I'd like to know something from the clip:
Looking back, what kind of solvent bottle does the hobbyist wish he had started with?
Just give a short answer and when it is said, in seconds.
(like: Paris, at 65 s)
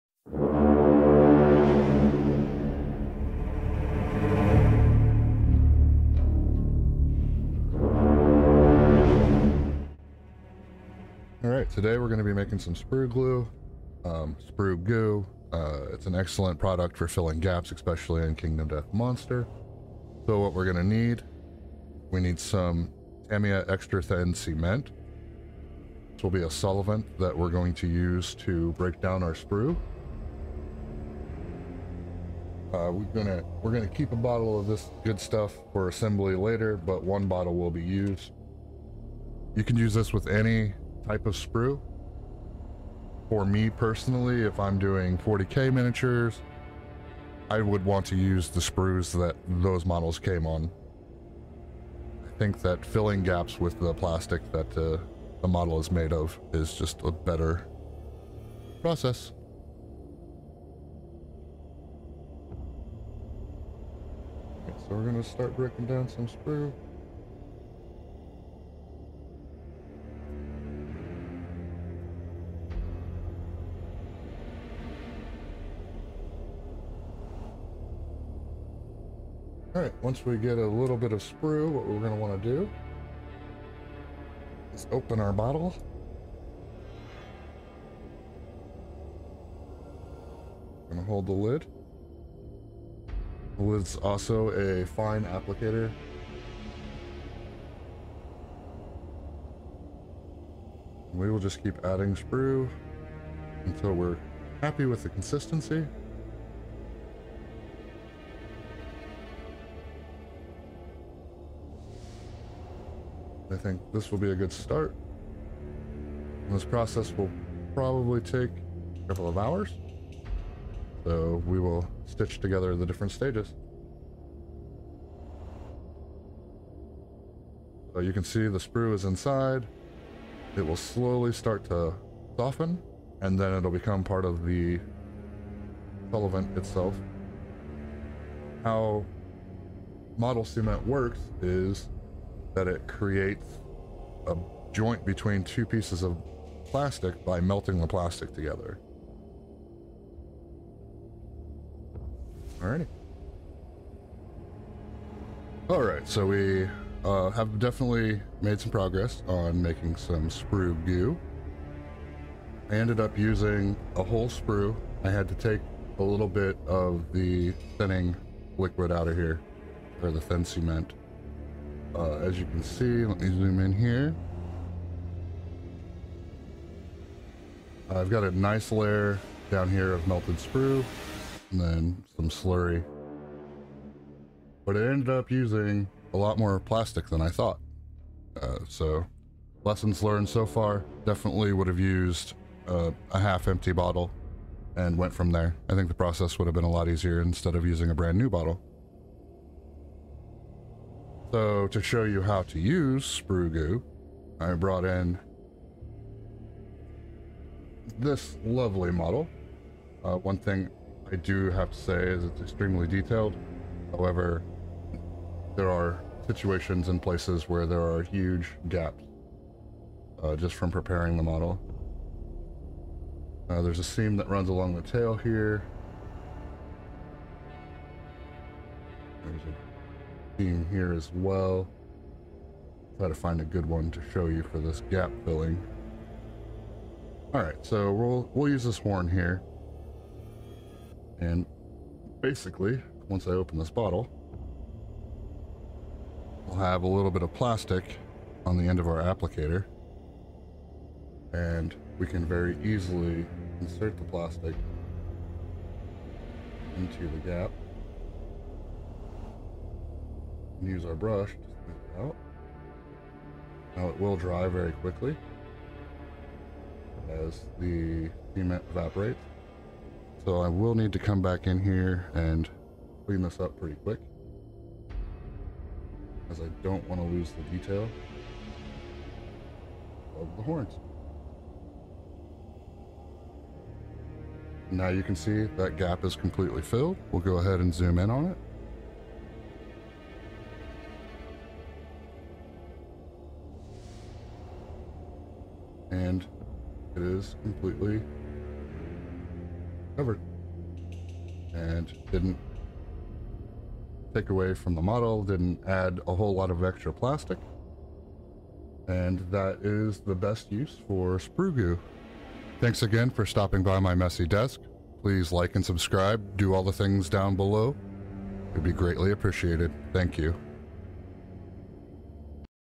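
A half empty bottle, at 193 s.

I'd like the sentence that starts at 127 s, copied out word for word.
So you can see the sprue is inside.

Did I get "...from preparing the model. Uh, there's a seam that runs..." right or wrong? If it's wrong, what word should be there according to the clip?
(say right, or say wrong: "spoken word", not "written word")
right.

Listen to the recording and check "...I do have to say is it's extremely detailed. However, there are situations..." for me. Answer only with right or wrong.
right.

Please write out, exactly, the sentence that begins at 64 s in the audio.
Okay, so we're going to start breaking down some sprue.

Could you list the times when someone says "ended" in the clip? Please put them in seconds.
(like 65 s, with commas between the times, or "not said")
162 s, 184 s.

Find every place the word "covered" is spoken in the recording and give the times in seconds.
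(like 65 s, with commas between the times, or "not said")
299 s.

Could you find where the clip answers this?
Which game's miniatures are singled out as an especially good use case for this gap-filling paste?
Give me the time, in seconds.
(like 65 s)
18 s.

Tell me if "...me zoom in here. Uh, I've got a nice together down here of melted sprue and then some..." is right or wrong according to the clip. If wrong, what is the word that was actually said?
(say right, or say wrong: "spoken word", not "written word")
wrong: "layer", not "together".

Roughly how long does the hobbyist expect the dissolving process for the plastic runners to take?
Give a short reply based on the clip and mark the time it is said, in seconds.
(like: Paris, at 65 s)
A couple of hours, at 119 s.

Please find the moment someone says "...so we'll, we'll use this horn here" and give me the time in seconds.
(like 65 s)
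237 s.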